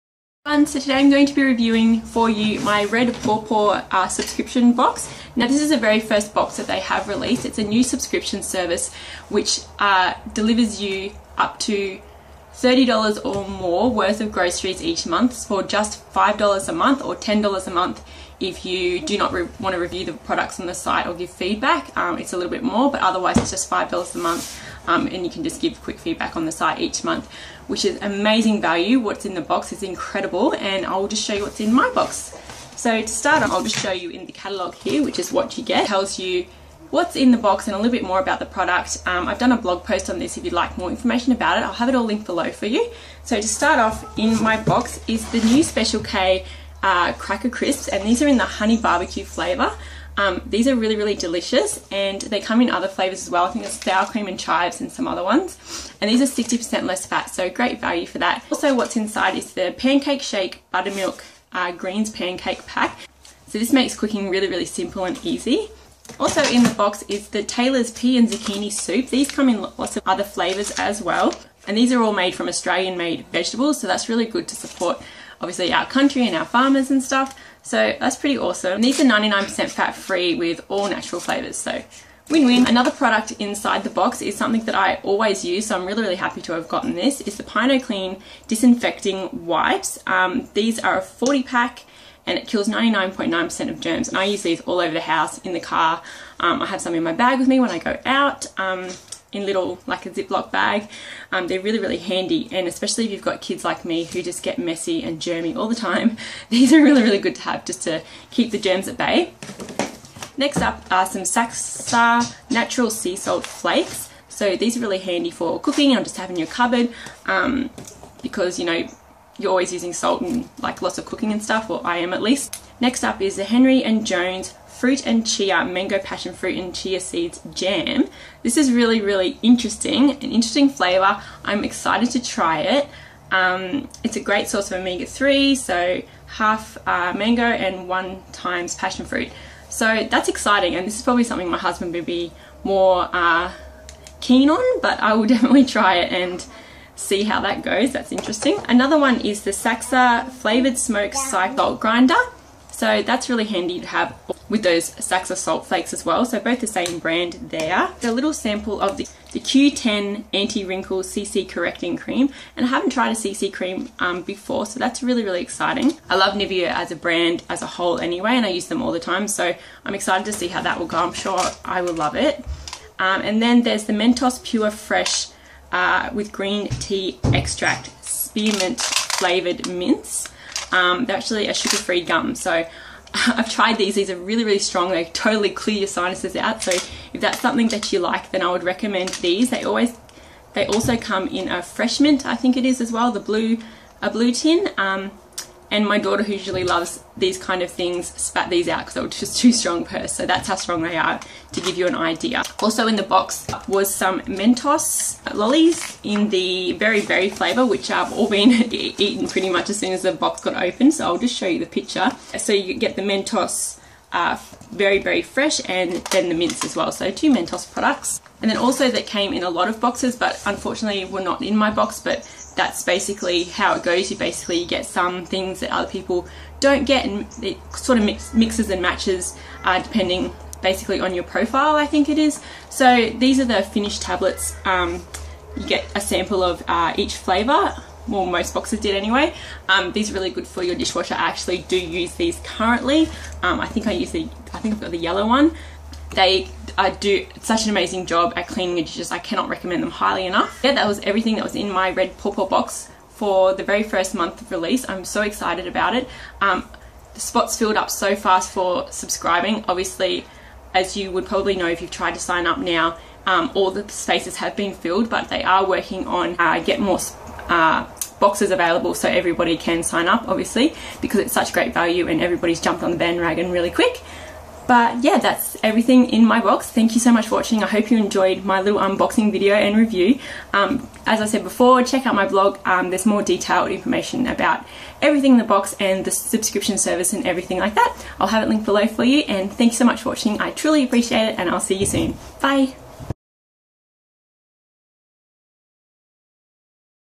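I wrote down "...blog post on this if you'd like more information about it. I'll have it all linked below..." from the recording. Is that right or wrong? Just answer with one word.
right.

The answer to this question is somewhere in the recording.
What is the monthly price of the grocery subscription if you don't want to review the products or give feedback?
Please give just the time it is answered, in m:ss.
0:17.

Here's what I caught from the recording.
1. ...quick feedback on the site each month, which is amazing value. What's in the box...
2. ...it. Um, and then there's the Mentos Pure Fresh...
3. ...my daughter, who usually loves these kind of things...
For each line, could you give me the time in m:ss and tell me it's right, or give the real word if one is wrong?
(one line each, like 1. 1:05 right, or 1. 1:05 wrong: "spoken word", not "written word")
1. 0:25 right
2. 2:52 right
3. 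3:15 right.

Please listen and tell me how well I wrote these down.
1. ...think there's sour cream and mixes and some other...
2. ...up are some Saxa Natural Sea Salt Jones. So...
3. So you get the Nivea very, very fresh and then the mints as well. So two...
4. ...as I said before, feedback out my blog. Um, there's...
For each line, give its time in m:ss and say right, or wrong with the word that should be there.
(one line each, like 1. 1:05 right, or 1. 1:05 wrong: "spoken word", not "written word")
1. 0:53 wrong: "chives", not "mixes"
2. 1:50 wrong: "Flakes", not "Jones"
3. 3:32 wrong: "Mentos", not "Nivea"
4. 4:41 wrong: "check", not "feedback".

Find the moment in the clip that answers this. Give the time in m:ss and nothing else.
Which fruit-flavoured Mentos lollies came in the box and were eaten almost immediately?
3:26.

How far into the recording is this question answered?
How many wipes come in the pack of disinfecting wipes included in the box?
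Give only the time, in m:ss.
1:31.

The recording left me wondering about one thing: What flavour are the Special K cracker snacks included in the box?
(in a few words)
Honey barbecue.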